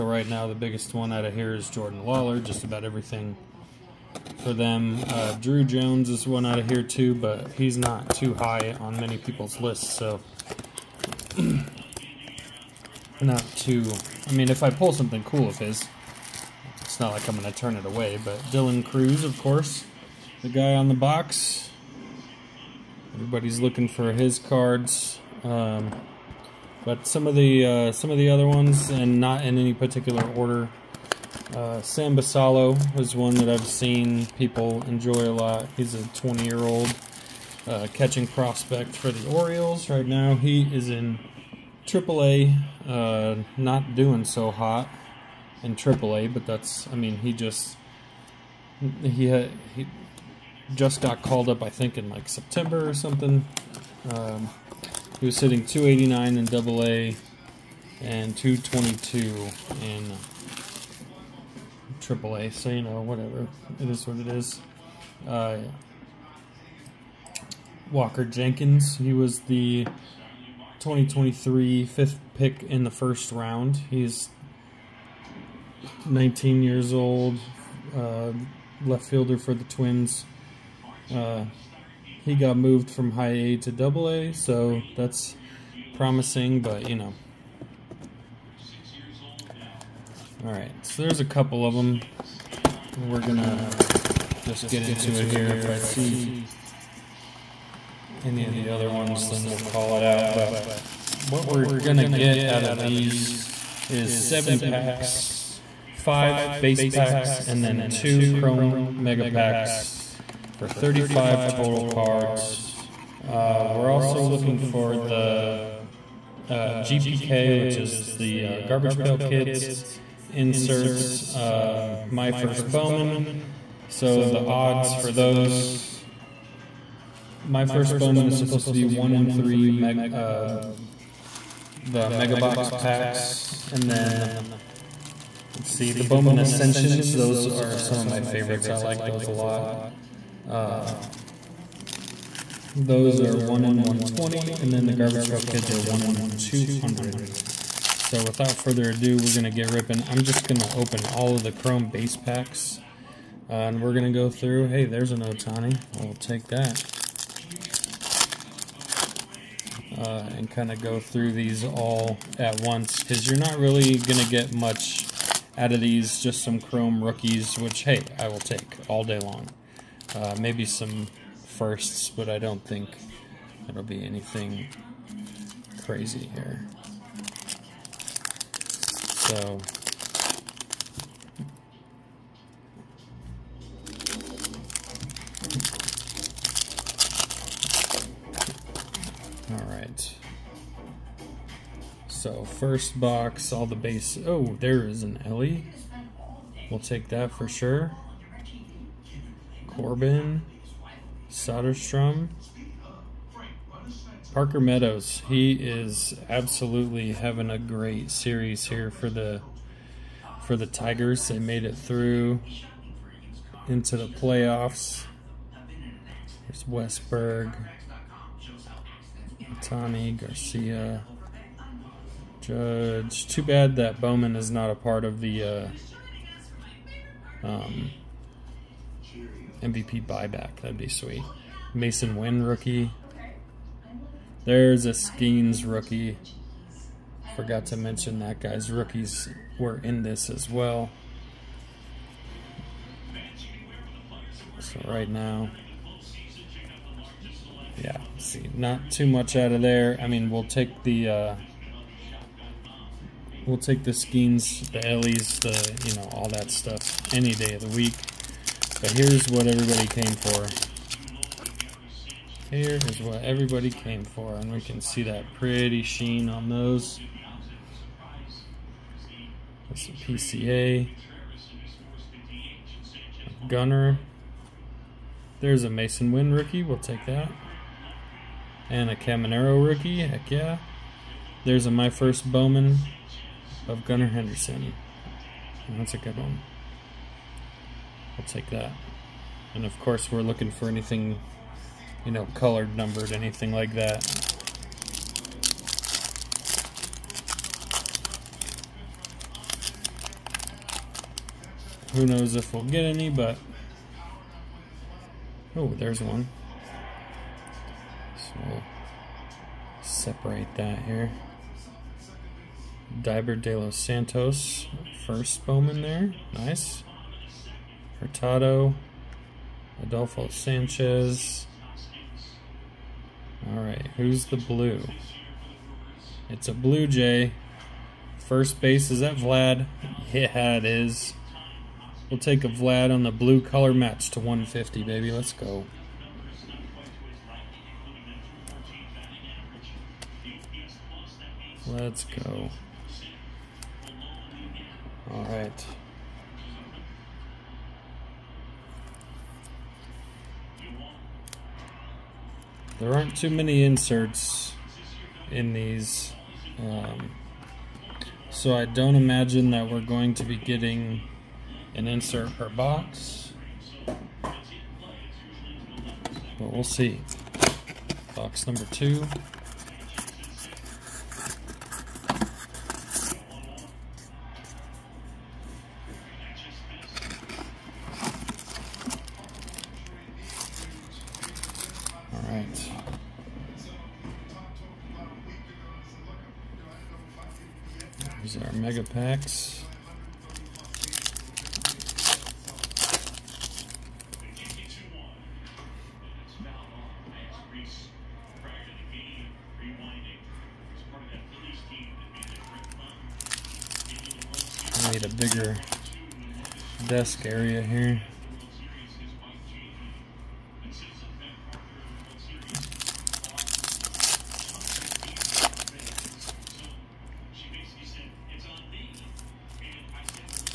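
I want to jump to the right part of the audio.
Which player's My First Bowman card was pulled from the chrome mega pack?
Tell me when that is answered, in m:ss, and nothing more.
4:43.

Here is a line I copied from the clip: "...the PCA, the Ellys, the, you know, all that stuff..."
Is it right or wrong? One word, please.
wrong.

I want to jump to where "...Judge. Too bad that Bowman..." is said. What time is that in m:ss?
3:42.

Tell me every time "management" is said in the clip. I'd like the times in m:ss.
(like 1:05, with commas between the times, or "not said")
not said.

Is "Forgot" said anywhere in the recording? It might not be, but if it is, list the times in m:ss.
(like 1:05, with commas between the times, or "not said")
3:57.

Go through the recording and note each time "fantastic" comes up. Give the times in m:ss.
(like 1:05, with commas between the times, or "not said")
not said.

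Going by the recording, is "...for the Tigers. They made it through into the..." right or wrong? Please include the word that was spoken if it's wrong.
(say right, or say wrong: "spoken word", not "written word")
right.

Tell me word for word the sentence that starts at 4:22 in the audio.
Here is what everybody came for, and we can see that pretty sheen on those.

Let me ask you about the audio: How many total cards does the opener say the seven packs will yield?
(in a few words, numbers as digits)
35.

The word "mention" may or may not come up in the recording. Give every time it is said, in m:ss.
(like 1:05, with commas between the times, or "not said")
3:57.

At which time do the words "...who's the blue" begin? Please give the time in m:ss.
5:23.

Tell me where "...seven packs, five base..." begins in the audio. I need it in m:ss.
1:44.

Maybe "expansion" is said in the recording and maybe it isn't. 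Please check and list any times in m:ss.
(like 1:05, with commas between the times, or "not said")
not said.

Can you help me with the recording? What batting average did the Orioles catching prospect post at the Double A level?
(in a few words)
289.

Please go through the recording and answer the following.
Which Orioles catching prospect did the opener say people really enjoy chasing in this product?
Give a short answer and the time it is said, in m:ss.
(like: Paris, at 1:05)
Sam Basallo, at 0:31.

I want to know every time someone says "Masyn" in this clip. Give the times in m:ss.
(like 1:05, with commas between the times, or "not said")
3:51, 4:35.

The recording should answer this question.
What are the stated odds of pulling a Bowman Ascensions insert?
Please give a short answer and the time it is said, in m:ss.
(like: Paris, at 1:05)
1 in 120, at 2:23.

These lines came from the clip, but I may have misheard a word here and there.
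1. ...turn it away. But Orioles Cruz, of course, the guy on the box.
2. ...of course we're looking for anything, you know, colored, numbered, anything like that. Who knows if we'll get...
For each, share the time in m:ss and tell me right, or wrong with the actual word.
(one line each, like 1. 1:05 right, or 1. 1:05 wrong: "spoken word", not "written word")
1. 0:17 wrong: "Dylan", not "Orioles"
2. 4:49 right.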